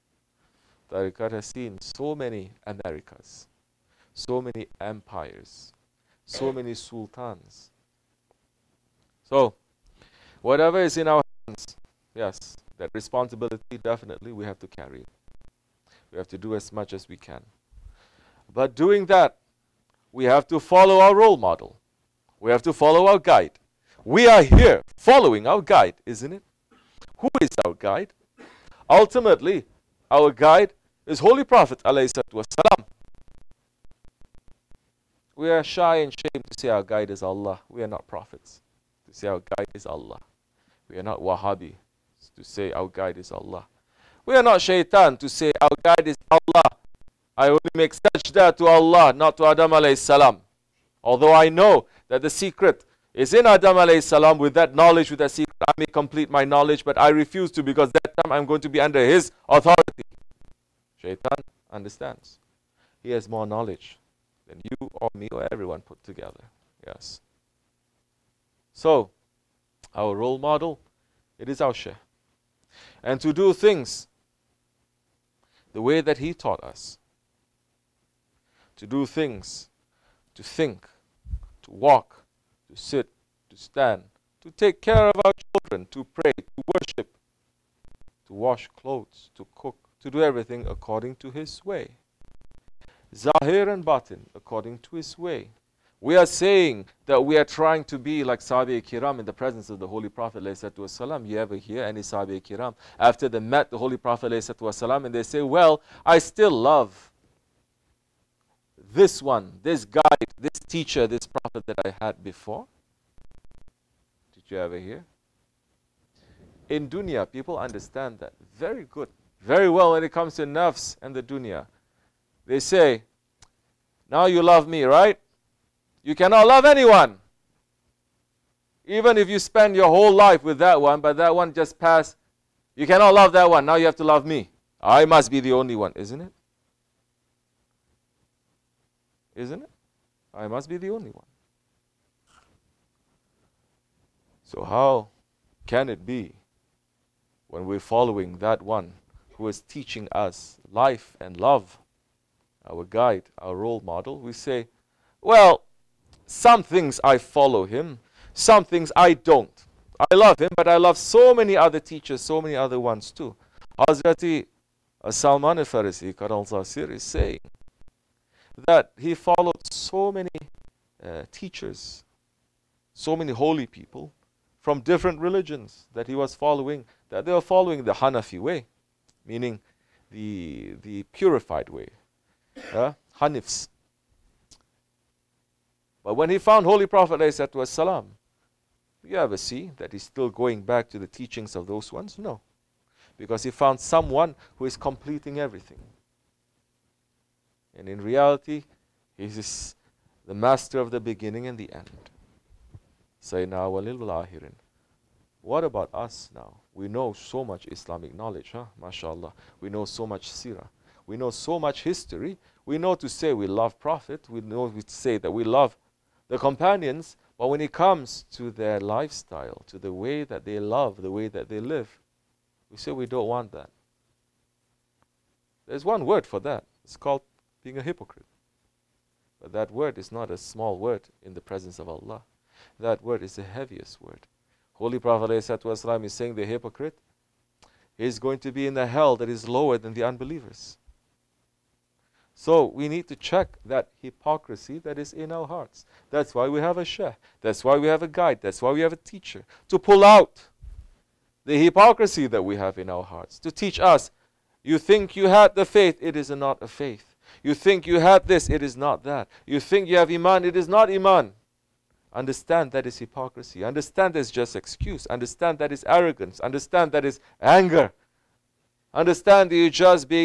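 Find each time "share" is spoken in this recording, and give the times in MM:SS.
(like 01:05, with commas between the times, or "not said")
01:11.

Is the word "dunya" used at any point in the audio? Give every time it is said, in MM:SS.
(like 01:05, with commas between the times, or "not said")
01:56, 02:01.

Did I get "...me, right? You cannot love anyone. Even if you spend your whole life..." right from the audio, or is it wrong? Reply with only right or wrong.
right.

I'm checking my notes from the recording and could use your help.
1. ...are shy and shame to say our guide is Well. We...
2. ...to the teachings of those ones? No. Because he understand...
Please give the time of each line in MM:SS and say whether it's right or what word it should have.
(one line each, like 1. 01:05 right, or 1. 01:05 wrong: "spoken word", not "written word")
1. 00:35 wrong: "Allah", not "Well"
2. 03:10 wrong: "found", not "understand".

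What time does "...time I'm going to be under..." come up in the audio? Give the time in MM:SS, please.
00:58.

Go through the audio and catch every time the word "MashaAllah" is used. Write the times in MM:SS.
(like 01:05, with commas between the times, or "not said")
03:28.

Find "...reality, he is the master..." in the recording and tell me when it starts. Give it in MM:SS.
03:17.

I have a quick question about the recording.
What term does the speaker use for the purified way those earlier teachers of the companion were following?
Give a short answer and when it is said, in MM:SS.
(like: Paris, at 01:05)
Hanifs, at 03:03.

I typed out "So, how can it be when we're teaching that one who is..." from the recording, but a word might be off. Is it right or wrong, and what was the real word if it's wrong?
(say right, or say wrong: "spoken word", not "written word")
wrong: "following", not "teaching".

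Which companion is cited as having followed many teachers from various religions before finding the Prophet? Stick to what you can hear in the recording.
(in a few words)
Salman al-Farisi.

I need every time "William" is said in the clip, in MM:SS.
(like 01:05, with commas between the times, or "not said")
not said.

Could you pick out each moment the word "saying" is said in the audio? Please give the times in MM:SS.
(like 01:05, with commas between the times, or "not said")
01:36, 02:47, 03:56.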